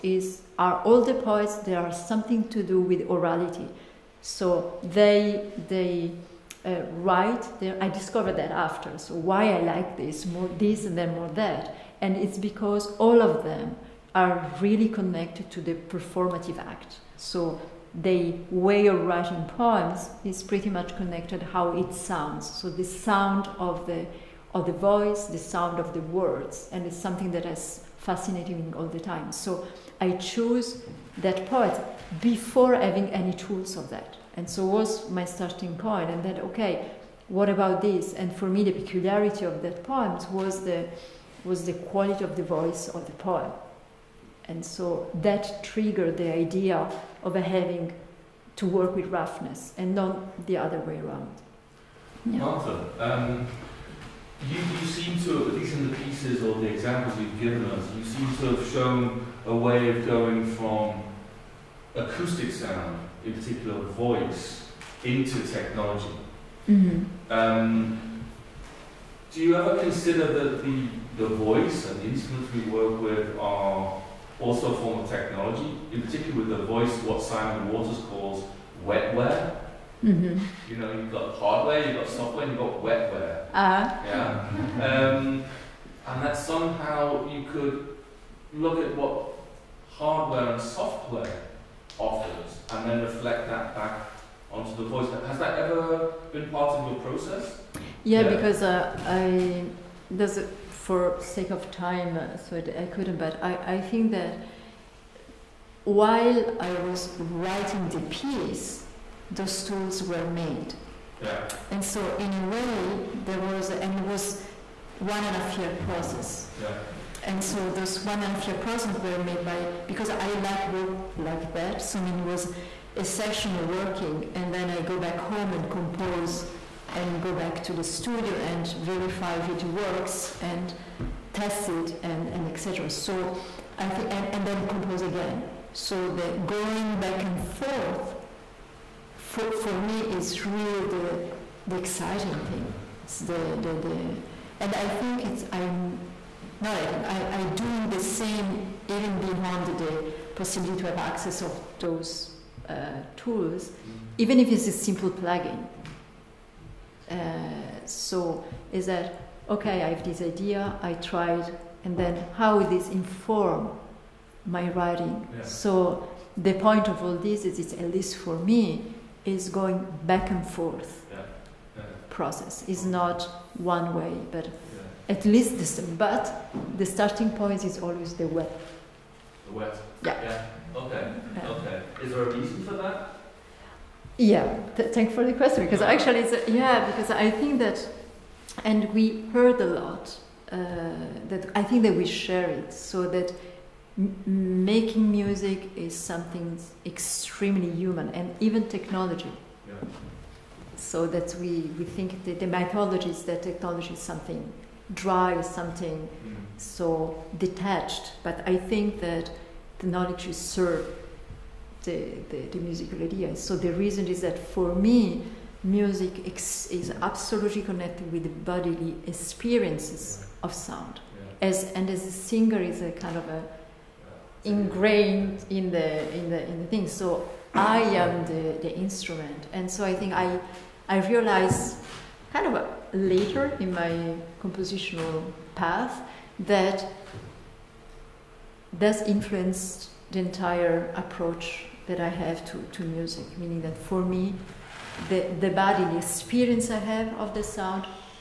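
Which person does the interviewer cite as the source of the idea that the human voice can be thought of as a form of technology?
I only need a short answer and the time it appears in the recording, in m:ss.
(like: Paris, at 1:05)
Simon Waters, at 1:17.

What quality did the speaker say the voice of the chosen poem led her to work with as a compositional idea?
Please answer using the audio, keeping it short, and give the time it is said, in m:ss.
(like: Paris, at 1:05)
roughness, at 0:49.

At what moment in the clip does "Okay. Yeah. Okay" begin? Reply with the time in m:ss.
3:00.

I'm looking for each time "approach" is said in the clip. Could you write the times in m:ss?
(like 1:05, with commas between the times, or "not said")
4:00.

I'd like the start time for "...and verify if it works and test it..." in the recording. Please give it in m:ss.
2:08.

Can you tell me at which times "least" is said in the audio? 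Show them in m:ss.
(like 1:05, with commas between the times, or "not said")
0:55, 2:47, 2:55.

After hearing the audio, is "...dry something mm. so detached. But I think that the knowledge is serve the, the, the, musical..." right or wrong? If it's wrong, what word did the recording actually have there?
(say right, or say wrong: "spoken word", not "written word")
right.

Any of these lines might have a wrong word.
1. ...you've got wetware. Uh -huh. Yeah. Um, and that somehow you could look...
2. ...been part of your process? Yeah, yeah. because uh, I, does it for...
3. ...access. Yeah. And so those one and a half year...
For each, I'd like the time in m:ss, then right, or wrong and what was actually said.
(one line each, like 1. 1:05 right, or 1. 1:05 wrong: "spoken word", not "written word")
1. 1:22 right
2. 1:36 right
3. 1:55 wrong: "process", not "access".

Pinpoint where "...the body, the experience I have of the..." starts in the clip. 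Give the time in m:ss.
4:05.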